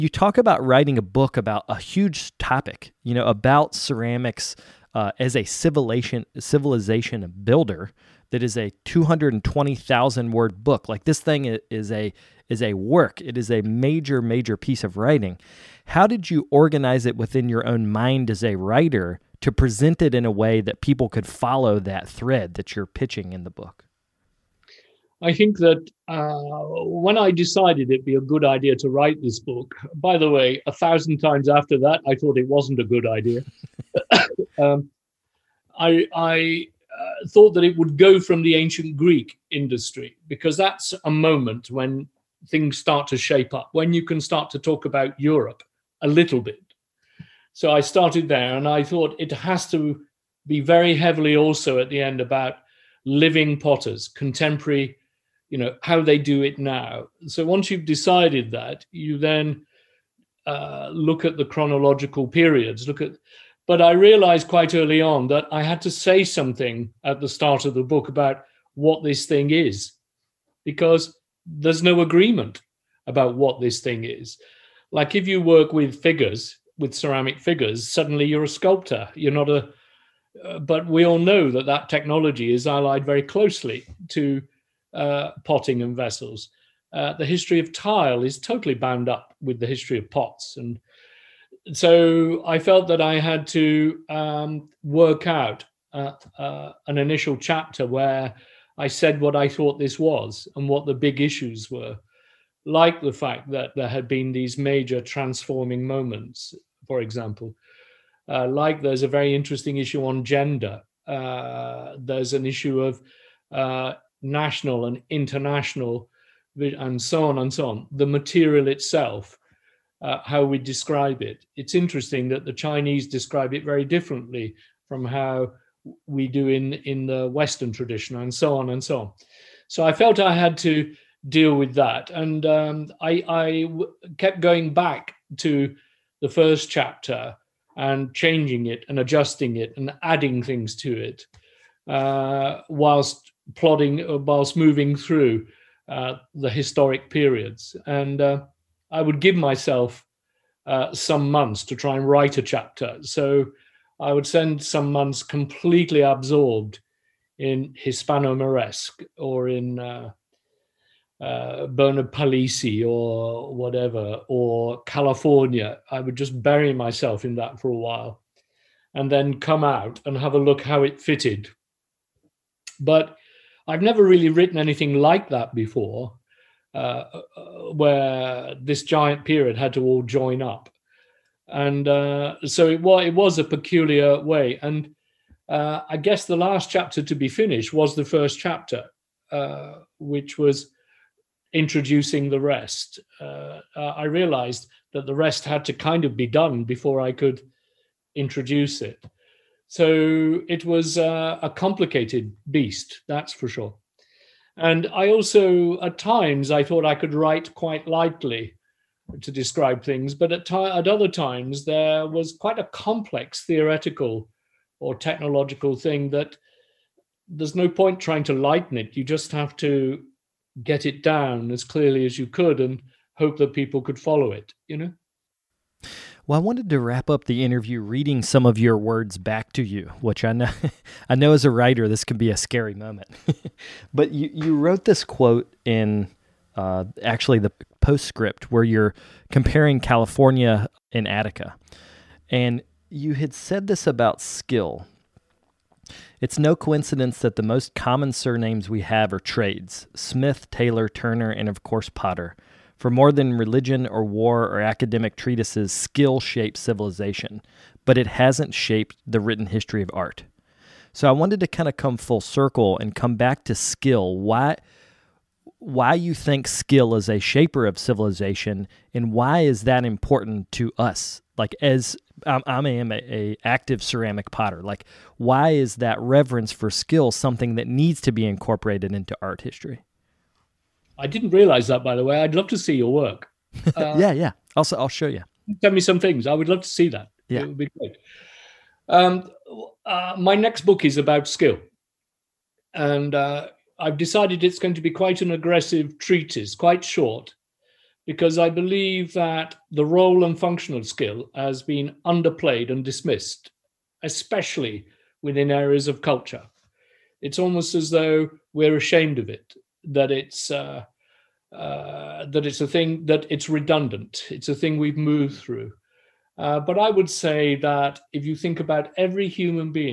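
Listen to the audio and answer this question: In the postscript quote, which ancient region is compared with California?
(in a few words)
Attica.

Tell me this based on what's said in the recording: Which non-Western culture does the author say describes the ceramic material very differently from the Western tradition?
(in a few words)
The Chinese.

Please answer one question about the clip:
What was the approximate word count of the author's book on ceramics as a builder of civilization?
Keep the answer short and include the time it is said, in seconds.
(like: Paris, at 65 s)
220,000, at 8 s.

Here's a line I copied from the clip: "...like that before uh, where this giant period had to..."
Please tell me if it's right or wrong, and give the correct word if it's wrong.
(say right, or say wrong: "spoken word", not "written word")
right.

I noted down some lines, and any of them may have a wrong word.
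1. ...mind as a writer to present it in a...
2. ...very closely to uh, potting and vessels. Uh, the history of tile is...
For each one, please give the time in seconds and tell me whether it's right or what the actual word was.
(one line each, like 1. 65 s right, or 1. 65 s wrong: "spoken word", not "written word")
1. 17 s right
2. 83 s right.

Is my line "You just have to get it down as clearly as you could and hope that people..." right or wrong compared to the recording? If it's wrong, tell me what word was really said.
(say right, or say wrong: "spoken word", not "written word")
right.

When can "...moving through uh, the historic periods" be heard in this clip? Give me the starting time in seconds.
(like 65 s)
144 s.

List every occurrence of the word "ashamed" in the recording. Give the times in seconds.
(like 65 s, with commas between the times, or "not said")
308 s.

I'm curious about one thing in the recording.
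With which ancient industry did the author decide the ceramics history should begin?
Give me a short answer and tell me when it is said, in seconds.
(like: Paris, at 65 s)
Ancient Greek, at 38 s.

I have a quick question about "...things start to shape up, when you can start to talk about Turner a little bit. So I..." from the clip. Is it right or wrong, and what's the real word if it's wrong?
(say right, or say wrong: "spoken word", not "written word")
wrong: "Europe", not "Turner".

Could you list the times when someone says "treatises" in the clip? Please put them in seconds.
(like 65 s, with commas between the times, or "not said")
255 s, 295 s.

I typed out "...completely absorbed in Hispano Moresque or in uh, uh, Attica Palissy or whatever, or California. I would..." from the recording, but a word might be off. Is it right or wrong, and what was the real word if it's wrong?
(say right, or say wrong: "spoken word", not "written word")
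wrong: "Bernard", not "Attica".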